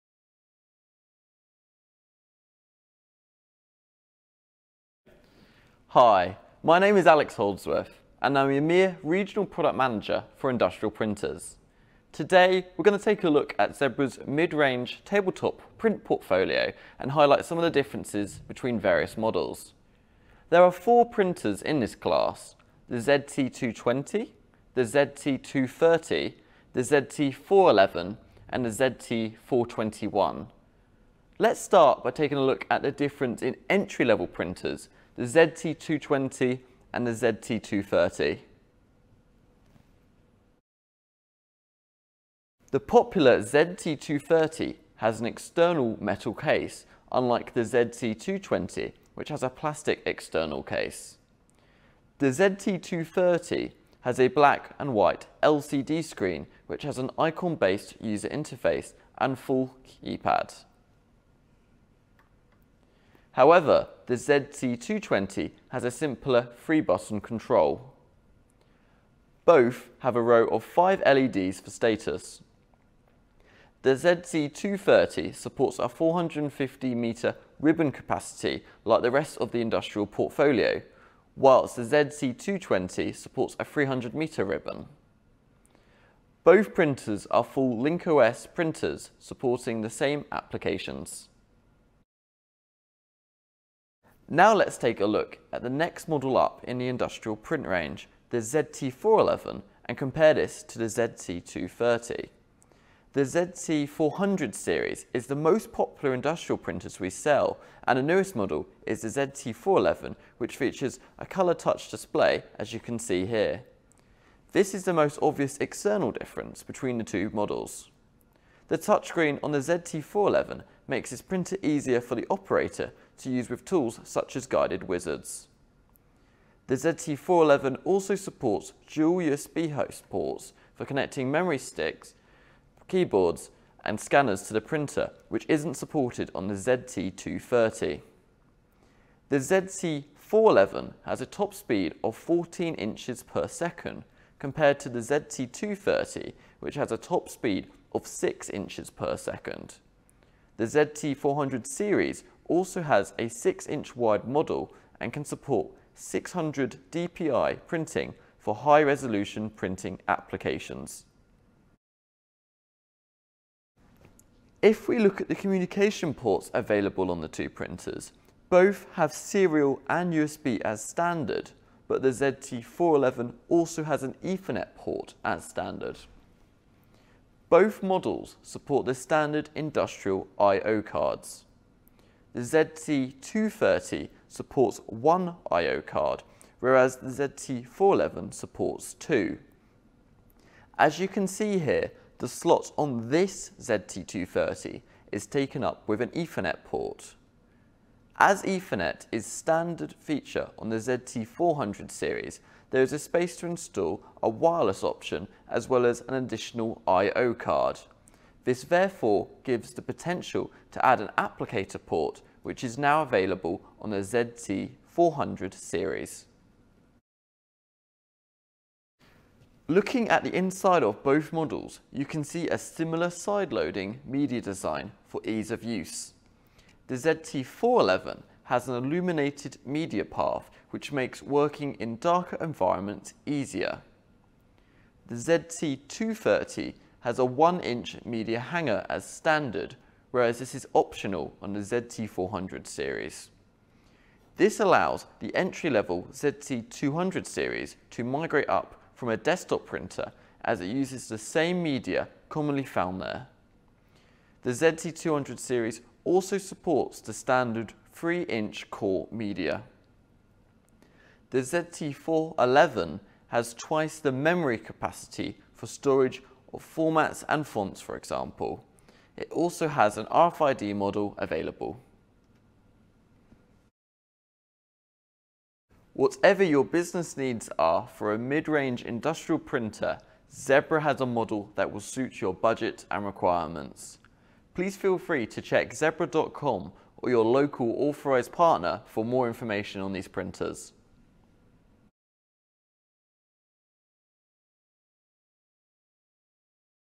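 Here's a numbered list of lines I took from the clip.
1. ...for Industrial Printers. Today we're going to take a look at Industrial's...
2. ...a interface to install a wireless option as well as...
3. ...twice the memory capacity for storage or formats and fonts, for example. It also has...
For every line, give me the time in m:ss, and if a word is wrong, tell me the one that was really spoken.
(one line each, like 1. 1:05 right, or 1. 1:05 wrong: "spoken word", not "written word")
1. 0:10 wrong: "Zebra", not "Industrial"
2. 3:22 wrong: "space", not "interface"
3. 4:23 right.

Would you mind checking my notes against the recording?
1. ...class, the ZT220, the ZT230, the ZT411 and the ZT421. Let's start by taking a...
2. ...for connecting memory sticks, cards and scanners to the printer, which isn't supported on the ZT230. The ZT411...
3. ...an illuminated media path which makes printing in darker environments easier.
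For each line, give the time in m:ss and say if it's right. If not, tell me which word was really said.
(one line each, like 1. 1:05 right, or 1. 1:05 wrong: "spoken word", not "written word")
1. 0:21 right
2. 2:10 wrong: "keyboards", not "cards"
3. 3:48 wrong: "working", not "printing".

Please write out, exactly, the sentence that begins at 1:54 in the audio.
This is the most obvious external difference between the two models.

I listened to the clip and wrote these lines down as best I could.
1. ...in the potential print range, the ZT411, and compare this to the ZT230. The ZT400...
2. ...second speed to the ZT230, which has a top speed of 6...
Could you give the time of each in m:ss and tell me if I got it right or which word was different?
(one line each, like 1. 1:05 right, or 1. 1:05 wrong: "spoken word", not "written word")
1. 1:36 wrong: "industrial", not "potential"
2. 2:23 wrong: "compared", not "speed".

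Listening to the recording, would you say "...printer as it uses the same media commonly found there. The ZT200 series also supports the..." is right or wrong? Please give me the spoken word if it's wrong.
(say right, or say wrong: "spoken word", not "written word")
right.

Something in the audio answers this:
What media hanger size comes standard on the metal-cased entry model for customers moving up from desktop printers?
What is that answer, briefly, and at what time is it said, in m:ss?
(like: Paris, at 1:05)
1-inch, at 3:57.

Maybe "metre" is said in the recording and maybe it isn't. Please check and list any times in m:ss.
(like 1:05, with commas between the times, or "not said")
1:16, 1:24.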